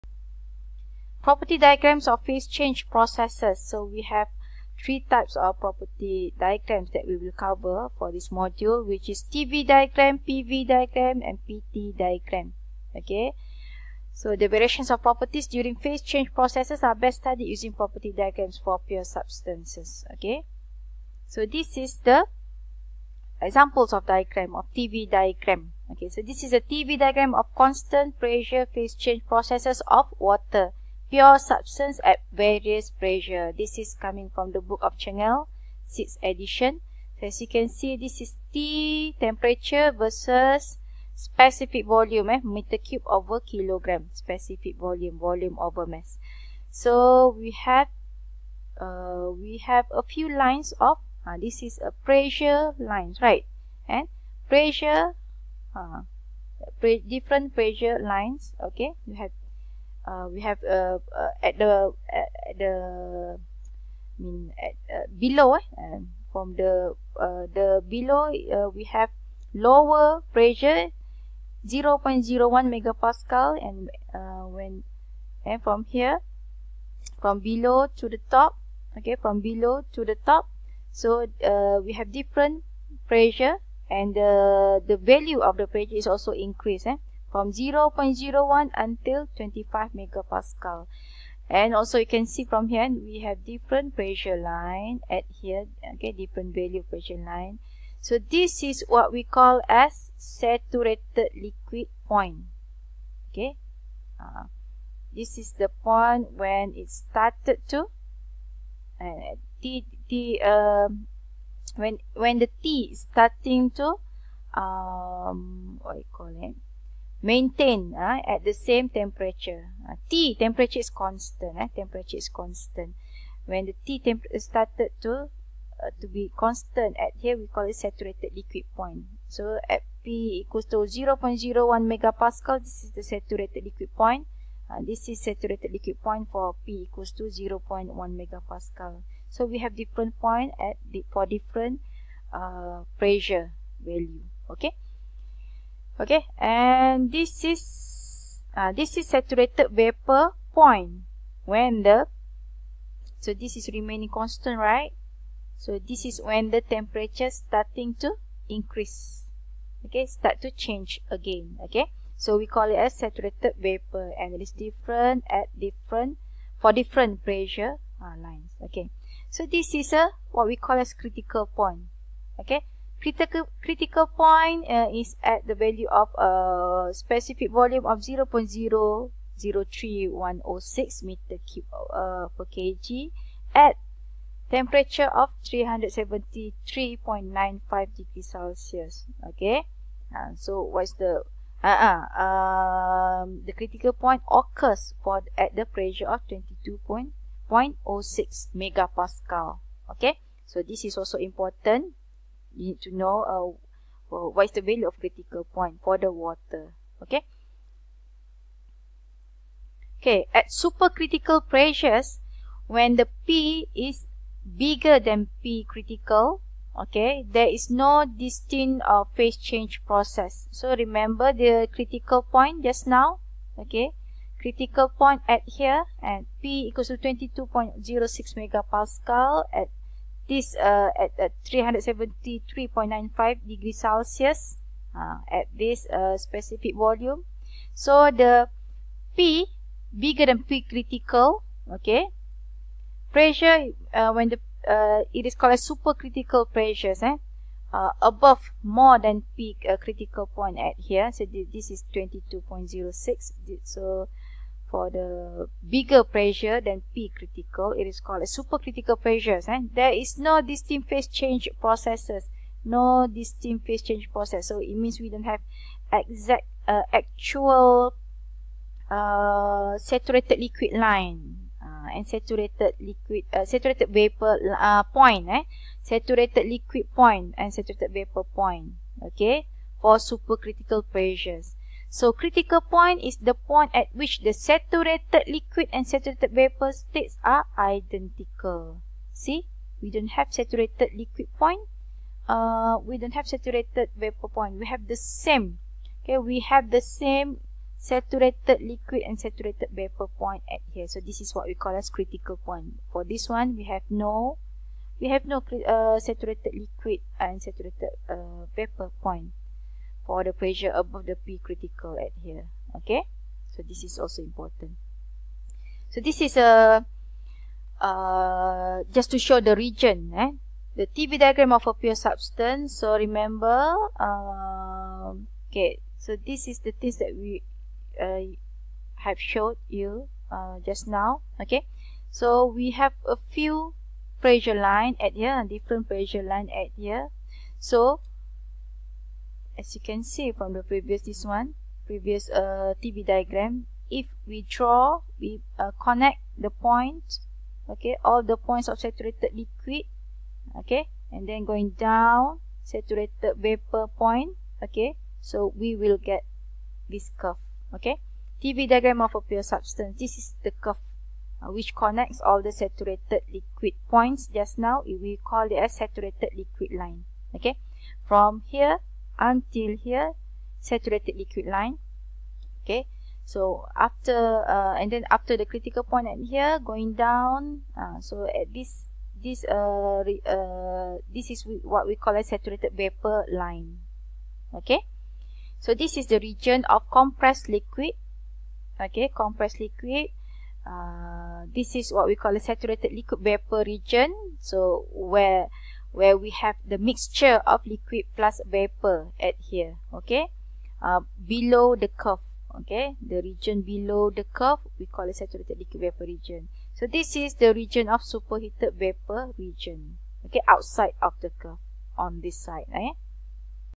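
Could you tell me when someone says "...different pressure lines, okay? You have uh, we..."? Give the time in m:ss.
0:57.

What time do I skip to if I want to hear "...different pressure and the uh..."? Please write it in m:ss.
1:22.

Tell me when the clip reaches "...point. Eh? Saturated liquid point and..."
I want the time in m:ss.
4:34.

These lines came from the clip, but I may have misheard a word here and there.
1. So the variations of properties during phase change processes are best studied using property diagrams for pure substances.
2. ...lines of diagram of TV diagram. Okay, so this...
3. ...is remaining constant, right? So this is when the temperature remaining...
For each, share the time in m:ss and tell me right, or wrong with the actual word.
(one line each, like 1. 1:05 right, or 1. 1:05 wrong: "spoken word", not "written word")
1. 0:14 right
2. 0:23 wrong: "examples", not "lines"
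3. 2:33 wrong: "starting", not "remaining".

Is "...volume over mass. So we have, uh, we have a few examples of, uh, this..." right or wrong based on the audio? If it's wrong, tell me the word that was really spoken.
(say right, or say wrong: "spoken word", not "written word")
wrong: "lines", not "examples".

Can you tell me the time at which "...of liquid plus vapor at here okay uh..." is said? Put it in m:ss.
6:37.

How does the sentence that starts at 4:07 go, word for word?
Uh, above more than peak uh, critical point at here, so th this is 22.06.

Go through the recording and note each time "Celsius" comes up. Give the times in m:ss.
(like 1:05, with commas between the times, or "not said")
3:08, 3:53.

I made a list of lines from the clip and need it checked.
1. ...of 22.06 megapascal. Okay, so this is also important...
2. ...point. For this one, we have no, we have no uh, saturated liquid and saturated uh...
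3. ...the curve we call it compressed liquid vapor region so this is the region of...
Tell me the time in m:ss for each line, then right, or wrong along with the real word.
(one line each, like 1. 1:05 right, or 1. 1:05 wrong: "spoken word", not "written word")
1. 3:16 right
2. 5:02 right
3. 6:44 wrong: "saturated", not "compressed".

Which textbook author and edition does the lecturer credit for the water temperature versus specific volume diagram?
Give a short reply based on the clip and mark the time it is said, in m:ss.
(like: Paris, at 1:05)
Çengel, 6th edition, at 0:34.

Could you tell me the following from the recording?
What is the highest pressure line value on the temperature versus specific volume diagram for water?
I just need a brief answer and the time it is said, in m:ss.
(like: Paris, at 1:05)
25 MPa, at 1:29.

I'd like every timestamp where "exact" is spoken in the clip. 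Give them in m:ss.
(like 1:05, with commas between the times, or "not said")
4:25.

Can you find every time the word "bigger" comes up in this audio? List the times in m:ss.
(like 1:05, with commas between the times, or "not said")
3:34, 3:59, 4:15.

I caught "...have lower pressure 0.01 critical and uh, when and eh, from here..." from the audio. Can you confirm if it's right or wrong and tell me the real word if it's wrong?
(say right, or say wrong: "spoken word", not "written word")
wrong: "megapascal", not "critical".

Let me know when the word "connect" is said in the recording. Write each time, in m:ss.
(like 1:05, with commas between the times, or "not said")
5:45, 6:01.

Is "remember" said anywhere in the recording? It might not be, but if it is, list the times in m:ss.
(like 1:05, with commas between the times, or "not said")
3:40, 5:22.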